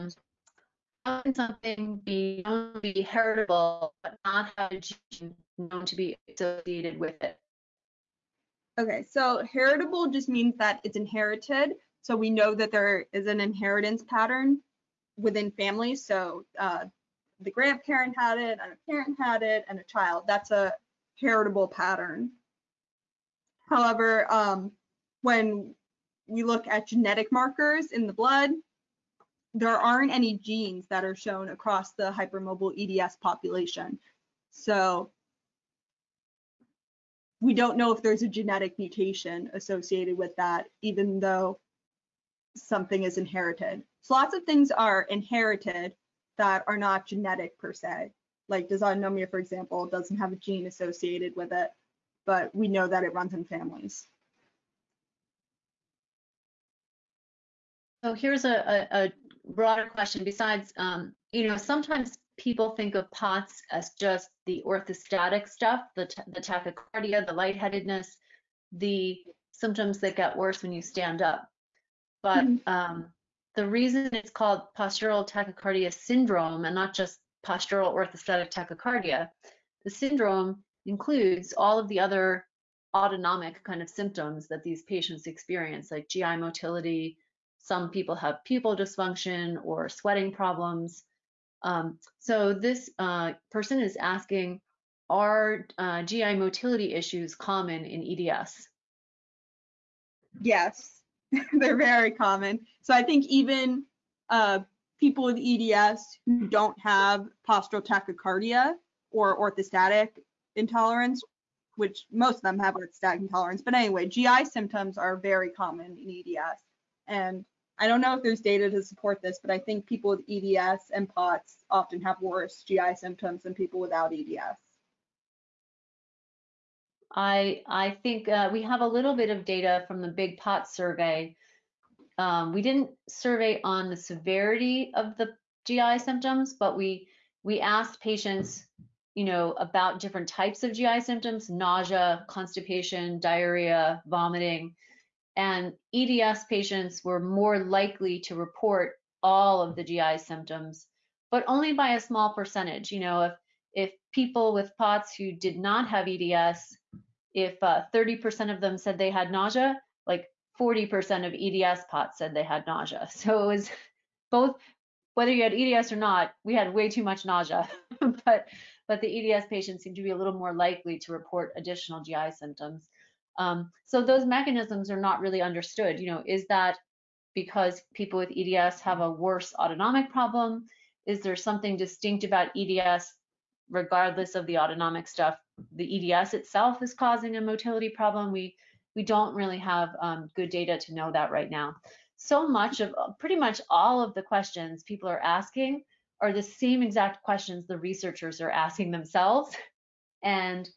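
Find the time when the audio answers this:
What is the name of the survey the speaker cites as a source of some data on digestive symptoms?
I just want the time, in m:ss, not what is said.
2:10.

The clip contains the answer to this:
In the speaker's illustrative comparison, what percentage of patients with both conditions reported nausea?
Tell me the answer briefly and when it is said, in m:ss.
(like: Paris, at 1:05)
40%, at 2:40.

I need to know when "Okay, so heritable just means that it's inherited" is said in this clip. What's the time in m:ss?
0:08.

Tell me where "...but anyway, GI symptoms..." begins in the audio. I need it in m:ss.
1:53.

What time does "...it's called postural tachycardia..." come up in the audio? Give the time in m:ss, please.
1:14.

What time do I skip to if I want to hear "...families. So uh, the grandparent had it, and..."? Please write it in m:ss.
0:15.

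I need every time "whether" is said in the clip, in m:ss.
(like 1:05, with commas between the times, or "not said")
2:45.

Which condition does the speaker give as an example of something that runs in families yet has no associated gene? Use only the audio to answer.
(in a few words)
Dysautonomia.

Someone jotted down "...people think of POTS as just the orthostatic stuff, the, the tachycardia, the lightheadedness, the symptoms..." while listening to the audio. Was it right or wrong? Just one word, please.
right.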